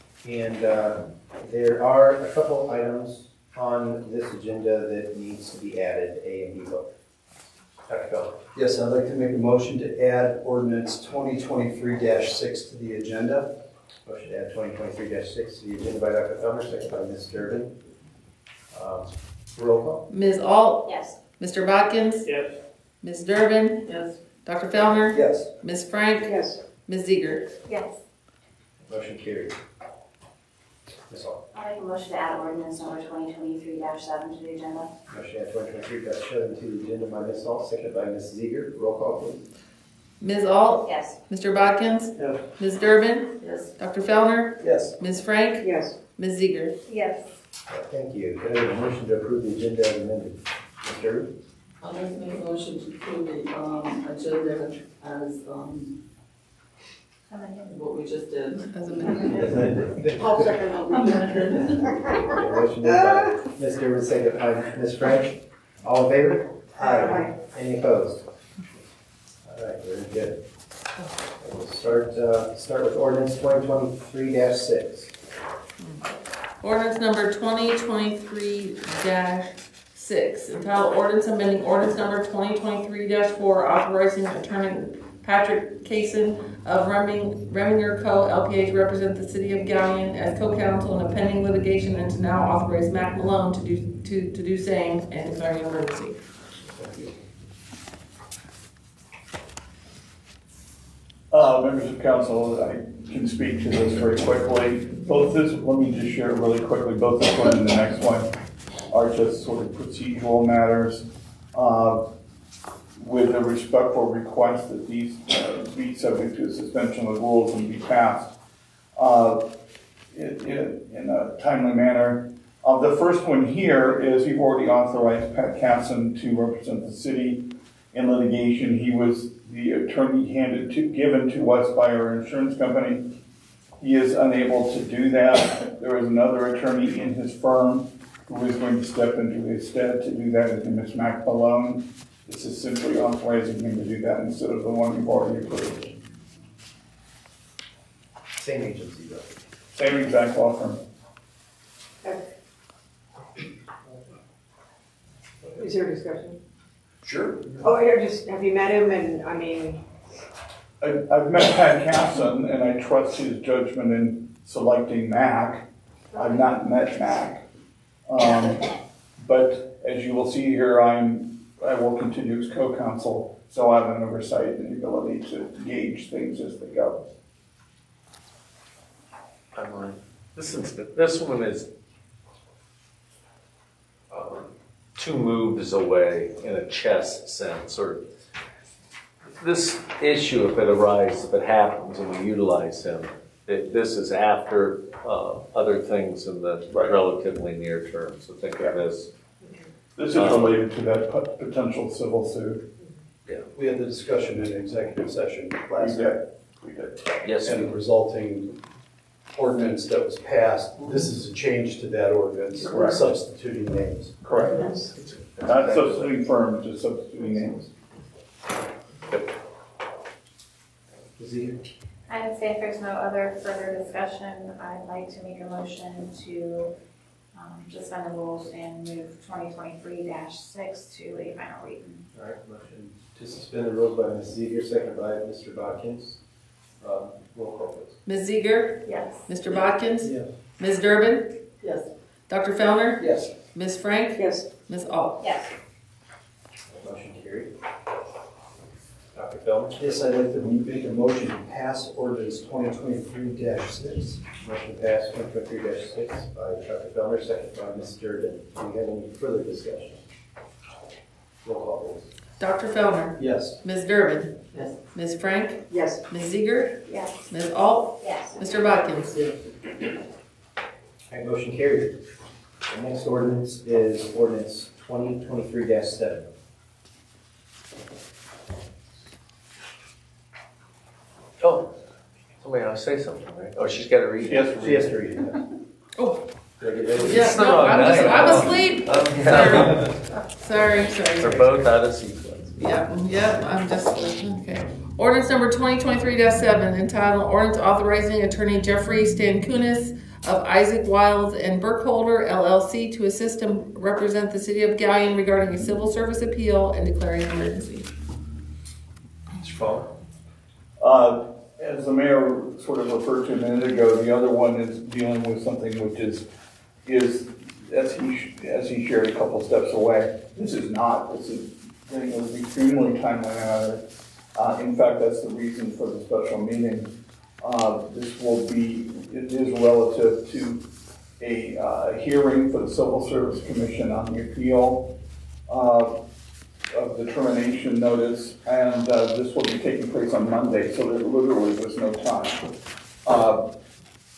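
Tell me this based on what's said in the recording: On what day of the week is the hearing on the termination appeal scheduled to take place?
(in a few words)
Monday.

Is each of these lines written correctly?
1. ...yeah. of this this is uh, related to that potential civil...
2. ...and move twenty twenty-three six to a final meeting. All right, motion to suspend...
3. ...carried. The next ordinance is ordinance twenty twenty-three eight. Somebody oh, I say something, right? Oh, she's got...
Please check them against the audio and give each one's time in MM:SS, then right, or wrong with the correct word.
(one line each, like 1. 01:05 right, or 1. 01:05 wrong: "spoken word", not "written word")
1. 03:18 right
2. 03:48 wrong: "reading", not "meeting"
3. 04:31 wrong: "seven", not "eight".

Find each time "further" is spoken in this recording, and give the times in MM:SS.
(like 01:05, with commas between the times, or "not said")
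03:43, 04:19.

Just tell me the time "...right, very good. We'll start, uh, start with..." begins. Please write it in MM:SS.
01:09.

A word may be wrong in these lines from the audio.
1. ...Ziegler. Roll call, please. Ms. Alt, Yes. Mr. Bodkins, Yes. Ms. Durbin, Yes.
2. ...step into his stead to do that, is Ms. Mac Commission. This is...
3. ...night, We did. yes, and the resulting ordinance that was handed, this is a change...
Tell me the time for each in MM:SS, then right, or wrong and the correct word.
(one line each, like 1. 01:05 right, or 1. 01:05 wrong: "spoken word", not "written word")
1. 00:38 right
2. 02:18 wrong: "Malone", not "Commission"
3. 03:25 wrong: "passed", not "handed".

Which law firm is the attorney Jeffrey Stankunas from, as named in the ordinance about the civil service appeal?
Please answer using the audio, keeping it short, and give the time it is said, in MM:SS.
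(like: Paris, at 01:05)
Isaac Wiles and Burkholder LLC, at 05:00.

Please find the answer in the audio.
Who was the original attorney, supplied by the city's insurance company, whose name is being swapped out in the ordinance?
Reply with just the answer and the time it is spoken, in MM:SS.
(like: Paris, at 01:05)
Patrick Kasson, at 01:25.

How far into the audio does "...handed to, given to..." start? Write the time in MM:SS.
02:10.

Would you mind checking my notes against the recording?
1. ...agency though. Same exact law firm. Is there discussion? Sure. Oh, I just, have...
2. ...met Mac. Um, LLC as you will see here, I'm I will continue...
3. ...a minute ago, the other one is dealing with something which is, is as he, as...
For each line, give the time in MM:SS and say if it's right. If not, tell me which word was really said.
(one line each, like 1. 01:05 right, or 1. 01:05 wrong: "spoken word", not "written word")
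1. 02:28 right
2. 02:46 wrong: "But", not "LLC"
3. 05:13 right.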